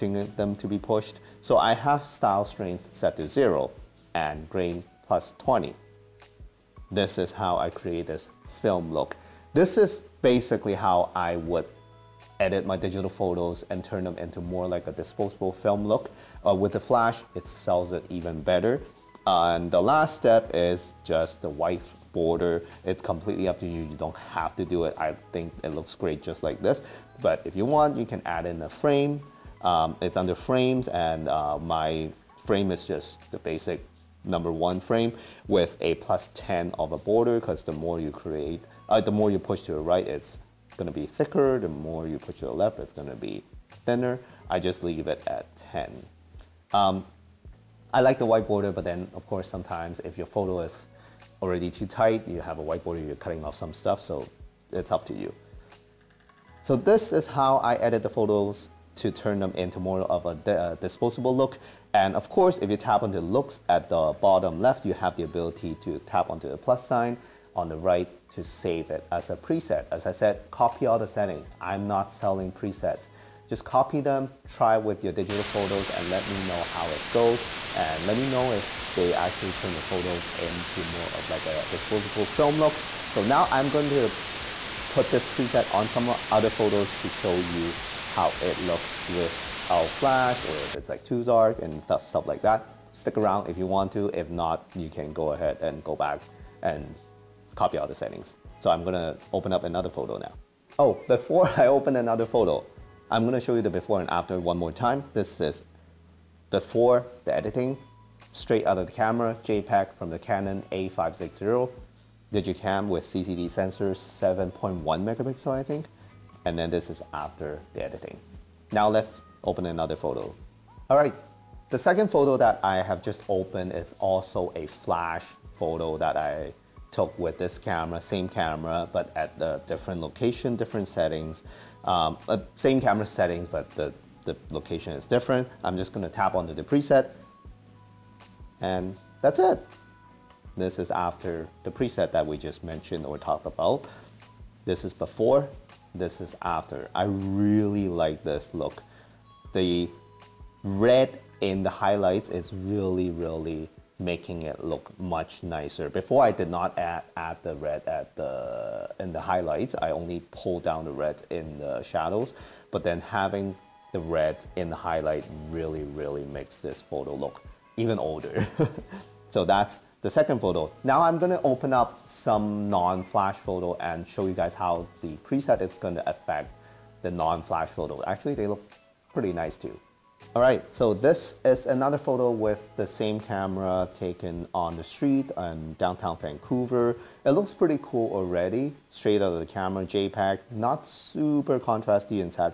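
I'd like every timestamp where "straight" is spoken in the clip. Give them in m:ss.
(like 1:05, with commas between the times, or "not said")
1:48, 3:08.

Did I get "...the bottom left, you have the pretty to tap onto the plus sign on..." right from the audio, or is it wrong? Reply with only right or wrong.
wrong.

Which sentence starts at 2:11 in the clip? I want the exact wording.
Um, uh, same camera settings, but the, the location is different.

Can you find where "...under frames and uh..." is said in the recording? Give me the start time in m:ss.
0:30.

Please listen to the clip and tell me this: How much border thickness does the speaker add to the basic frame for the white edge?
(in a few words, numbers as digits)
+10.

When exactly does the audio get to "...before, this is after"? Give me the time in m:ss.
2:24.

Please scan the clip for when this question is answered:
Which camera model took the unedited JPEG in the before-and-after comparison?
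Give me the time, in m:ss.
1:50.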